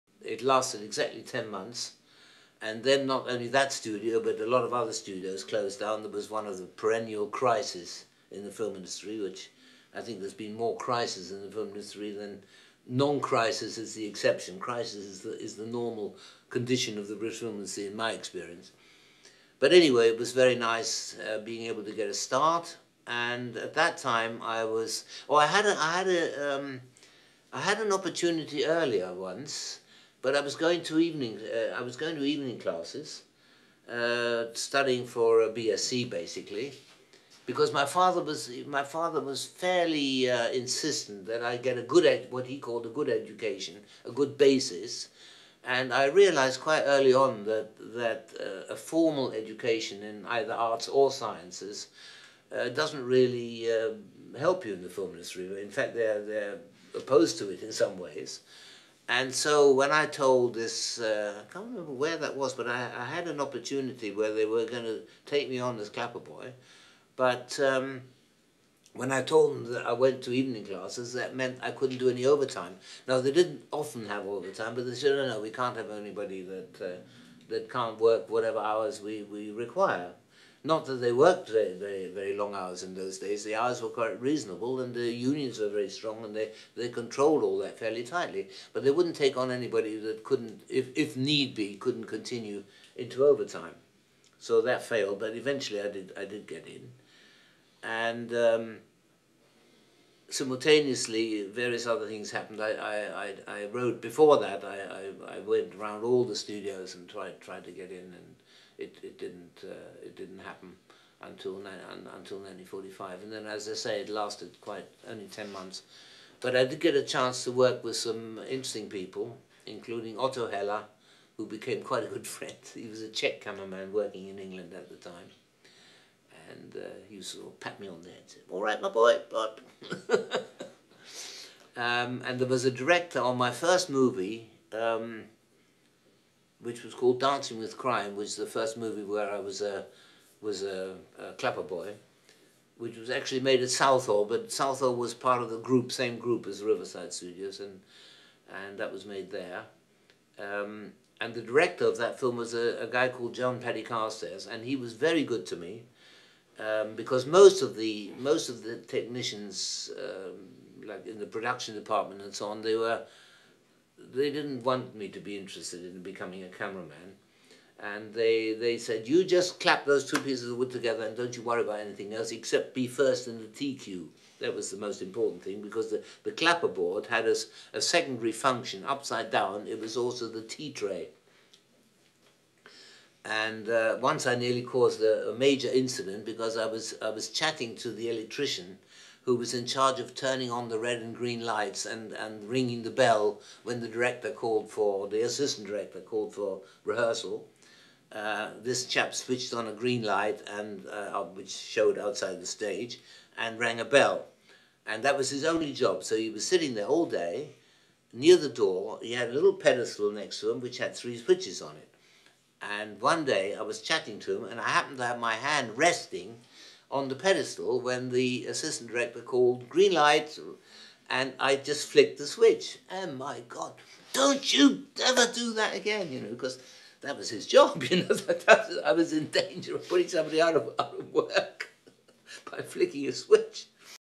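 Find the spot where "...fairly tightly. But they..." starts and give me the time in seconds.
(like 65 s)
87 s.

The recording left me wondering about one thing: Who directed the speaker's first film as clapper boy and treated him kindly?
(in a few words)
John Paddy Carstairs.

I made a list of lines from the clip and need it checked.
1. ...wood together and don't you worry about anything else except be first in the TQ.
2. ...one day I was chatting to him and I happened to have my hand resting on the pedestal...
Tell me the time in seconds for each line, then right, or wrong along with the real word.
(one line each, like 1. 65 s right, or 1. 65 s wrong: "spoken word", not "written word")
1. 170 s right
2. 212 s right.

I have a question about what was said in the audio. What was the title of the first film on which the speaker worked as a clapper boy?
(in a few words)
Dancing with Crime.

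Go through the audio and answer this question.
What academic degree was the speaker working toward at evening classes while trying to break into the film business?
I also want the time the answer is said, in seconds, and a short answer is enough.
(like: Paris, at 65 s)
BSc, at 35 s.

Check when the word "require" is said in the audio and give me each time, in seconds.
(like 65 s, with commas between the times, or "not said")
79 s.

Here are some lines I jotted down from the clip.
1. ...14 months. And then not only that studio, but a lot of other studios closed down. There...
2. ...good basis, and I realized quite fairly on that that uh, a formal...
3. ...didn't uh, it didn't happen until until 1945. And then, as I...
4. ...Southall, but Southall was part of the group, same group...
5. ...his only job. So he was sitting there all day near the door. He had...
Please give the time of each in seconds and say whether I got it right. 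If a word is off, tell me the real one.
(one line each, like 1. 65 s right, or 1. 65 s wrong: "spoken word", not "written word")
1. 1 s wrong: "10", not "14"
2. 44 s wrong: "early", not "fairly"
3. 109 s right
4. 143 s right
5. 205 s right.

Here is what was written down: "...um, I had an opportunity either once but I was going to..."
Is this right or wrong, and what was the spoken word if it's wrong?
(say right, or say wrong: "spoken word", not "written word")
wrong: "earlier", not "either".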